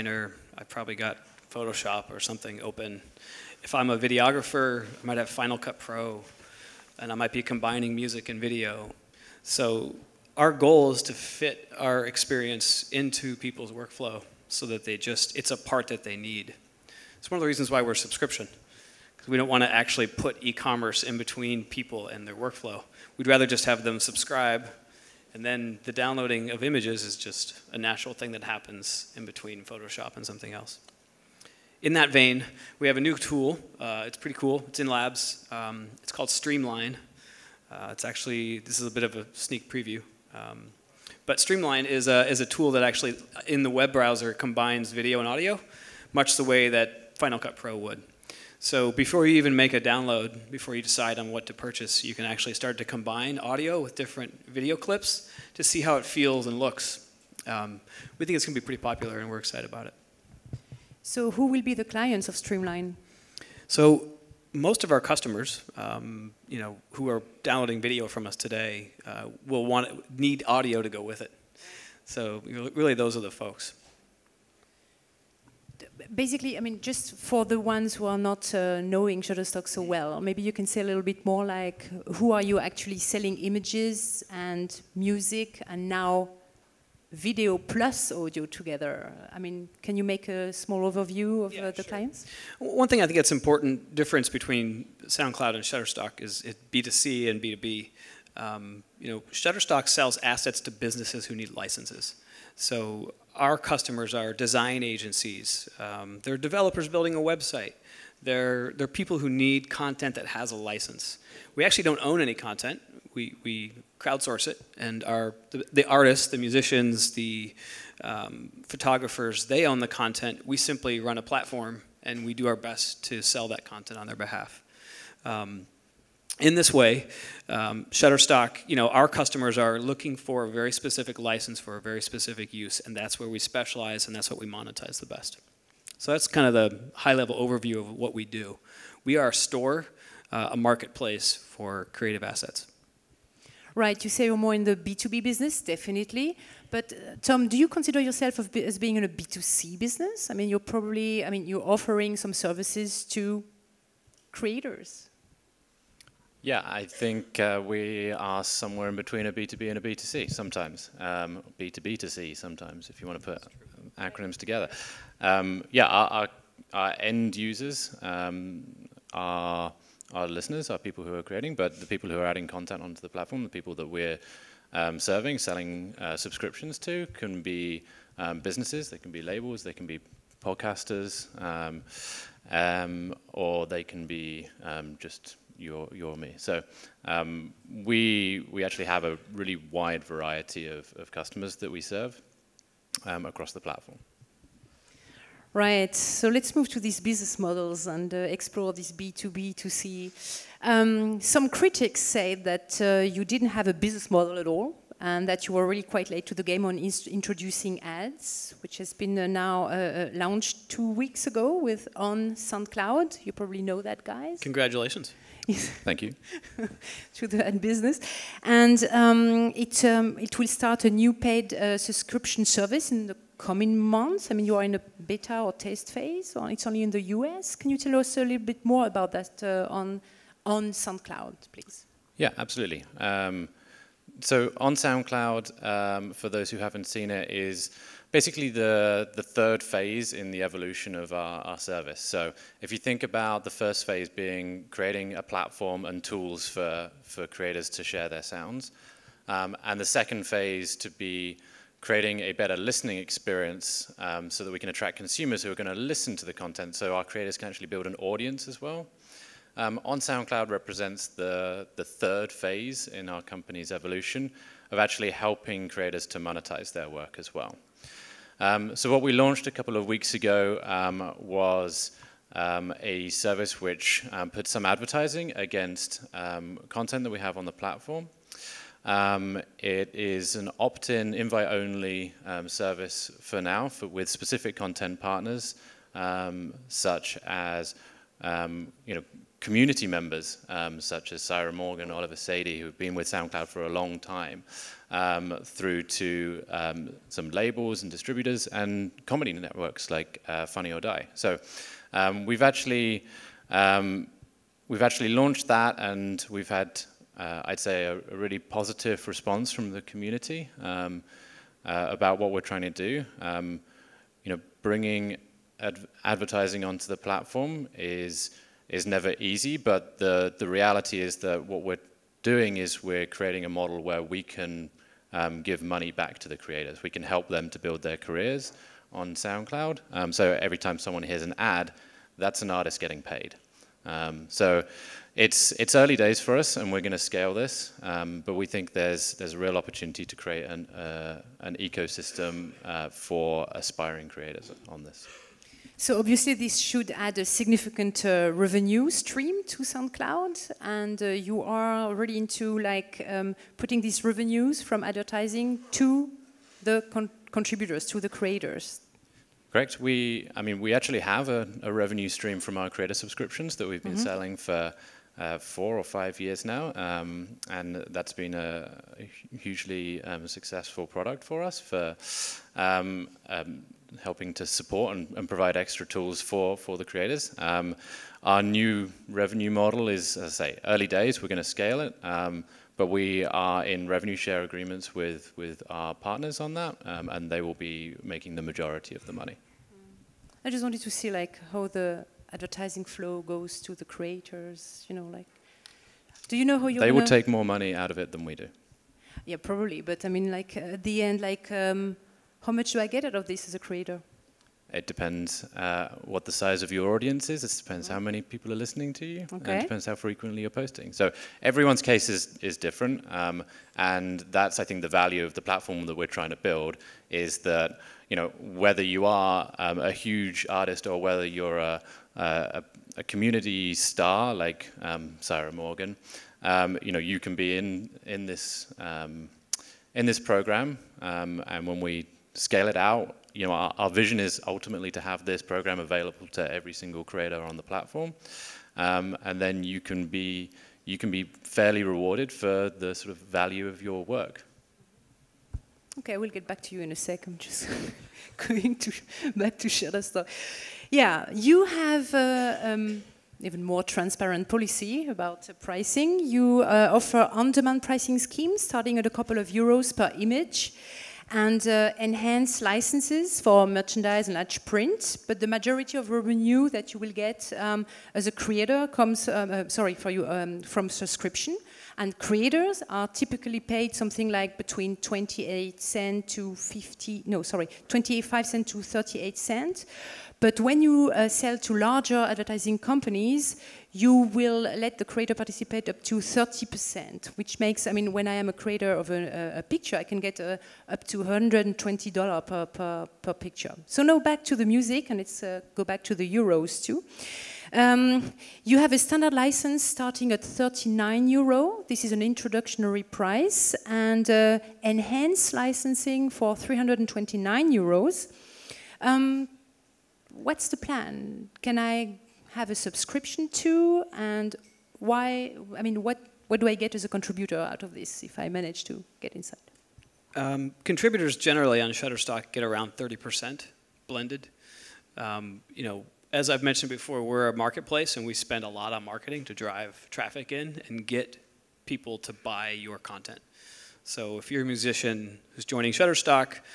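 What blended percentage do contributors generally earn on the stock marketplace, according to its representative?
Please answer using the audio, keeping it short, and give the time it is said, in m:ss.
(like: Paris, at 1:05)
30%, at 8:42.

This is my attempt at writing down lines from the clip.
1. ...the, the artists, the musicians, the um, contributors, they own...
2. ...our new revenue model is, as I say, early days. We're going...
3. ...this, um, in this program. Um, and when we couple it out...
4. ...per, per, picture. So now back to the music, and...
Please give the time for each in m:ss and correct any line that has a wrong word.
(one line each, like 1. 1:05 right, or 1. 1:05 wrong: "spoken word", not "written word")
1. 1:55 wrong: "photographers", not "contributors"
2. 6:18 right
3. 7:08 wrong: "scale", not "couple"
4. 8:12 right.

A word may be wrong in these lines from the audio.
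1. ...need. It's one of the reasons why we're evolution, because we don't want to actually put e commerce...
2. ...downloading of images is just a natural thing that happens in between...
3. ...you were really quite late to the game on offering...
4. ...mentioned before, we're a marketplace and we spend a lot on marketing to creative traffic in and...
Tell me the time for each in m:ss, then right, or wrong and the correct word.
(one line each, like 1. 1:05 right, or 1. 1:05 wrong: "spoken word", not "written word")
1. 0:16 wrong: "subscription", not "evolution"
2. 0:25 right
3. 3:25 wrong: "introducing", not "offering"
4. 8:46 wrong: "drive", not "creative".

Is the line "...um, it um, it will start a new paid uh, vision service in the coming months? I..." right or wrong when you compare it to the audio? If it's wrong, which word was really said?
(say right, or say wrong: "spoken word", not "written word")
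wrong: "subscription", not "vision".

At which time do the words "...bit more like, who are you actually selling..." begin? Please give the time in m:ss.
1:21.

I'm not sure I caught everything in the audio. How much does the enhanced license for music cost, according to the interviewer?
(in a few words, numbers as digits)
329 euros.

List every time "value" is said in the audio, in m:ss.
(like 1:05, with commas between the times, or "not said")
6:54, 7:23.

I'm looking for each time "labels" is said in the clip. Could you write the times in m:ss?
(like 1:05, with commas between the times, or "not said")
2:59, 4:57.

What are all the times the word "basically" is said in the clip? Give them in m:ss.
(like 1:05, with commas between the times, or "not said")
1:16, 3:58.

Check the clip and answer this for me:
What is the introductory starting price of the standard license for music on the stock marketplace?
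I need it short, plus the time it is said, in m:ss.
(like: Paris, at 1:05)
39 euros, at 8:20.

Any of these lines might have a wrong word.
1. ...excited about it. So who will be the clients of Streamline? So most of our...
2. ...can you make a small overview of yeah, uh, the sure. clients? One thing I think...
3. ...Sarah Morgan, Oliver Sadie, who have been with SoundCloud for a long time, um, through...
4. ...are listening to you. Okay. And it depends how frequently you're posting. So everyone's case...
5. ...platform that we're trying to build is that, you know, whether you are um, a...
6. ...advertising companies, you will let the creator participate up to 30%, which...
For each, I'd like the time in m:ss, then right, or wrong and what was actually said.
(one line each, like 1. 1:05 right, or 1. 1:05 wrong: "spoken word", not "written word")
1. 0:59 right
2. 1:29 right
3. 4:51 right
4. 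6:48 right
5. 6:55 right
6. 8:02 right.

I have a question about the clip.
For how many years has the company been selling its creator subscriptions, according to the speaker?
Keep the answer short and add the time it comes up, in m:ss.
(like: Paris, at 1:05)
4 or 5 years, at 6:05.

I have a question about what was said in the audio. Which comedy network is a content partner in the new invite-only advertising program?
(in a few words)
Funny or Die.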